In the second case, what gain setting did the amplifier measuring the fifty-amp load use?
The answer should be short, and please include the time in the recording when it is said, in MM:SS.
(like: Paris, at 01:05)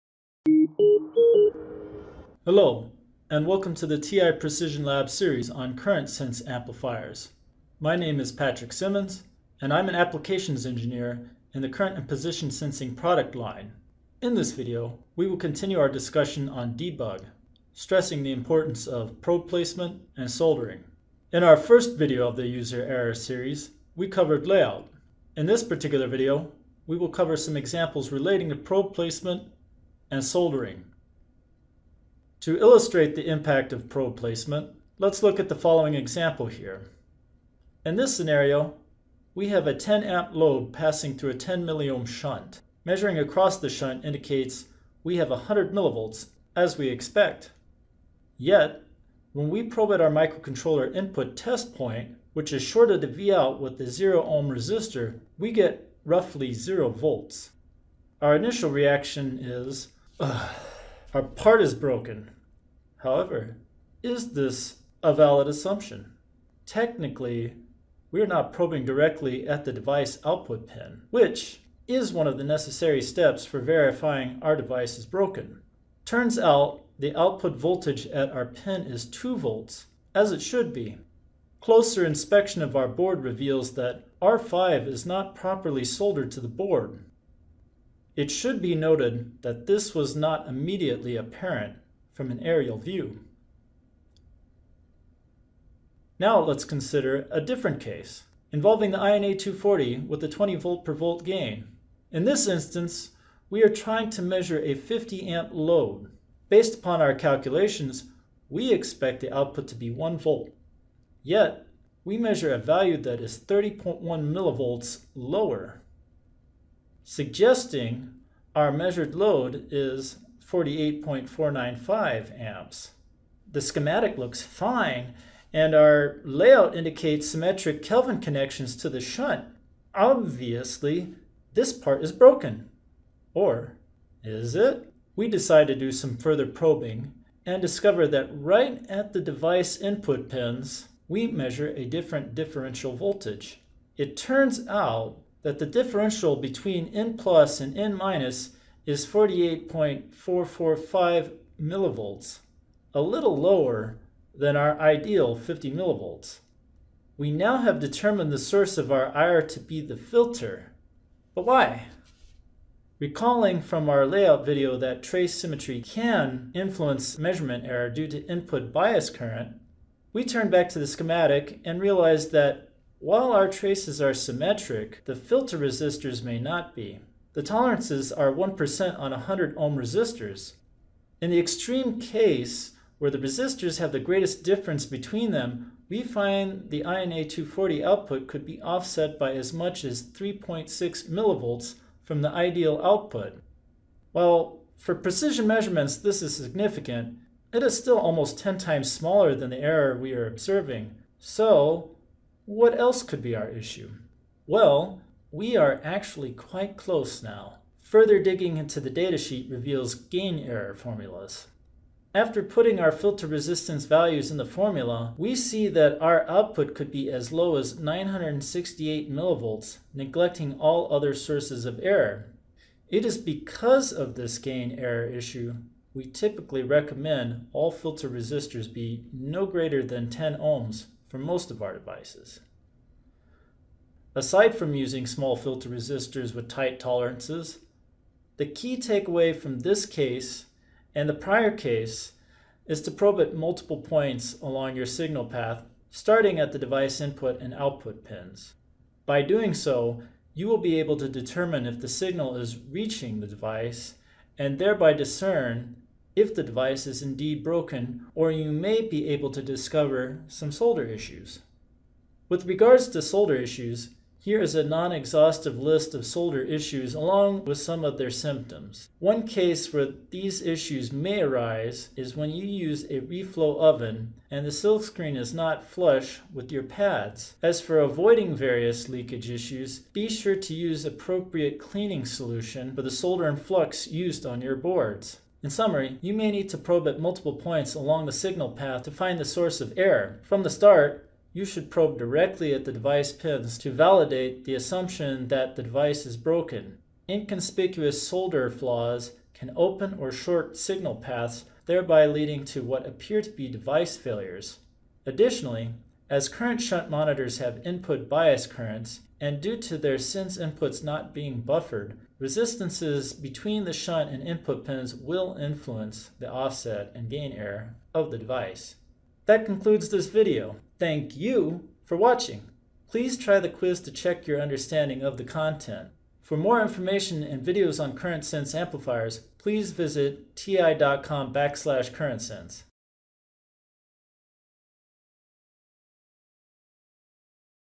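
20 V/V, at 01:40.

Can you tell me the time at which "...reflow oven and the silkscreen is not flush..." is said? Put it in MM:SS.
04:33.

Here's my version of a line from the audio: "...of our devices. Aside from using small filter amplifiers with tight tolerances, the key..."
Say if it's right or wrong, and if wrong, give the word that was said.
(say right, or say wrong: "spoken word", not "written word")
wrong: "resistors", not "amplifiers".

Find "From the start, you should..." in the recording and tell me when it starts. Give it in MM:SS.
04:50.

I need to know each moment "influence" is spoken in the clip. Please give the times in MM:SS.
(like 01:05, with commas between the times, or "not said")
02:46, 05:15.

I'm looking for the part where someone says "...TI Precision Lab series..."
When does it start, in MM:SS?
00:03.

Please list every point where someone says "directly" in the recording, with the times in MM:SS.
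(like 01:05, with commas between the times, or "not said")
01:08, 04:51.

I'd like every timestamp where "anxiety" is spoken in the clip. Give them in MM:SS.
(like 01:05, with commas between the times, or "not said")
not said.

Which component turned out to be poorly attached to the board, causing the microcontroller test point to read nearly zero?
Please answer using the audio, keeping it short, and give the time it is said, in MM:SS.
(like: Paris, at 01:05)
R5, at 01:24.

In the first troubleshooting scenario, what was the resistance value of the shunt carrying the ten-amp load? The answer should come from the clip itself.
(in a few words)
10 milliohm.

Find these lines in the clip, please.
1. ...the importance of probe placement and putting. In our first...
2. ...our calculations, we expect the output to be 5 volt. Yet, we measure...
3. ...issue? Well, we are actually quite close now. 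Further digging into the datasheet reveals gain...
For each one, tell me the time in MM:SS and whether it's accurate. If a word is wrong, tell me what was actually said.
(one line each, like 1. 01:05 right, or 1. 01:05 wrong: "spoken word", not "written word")
1. 00:18 wrong: "soldering", not "putting"
2. 01:47 wrong: "1", not "5"
3. 03:23 right.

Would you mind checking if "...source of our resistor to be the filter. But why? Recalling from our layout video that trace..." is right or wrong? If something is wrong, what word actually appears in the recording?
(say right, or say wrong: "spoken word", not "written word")
wrong: "error", not "resistor".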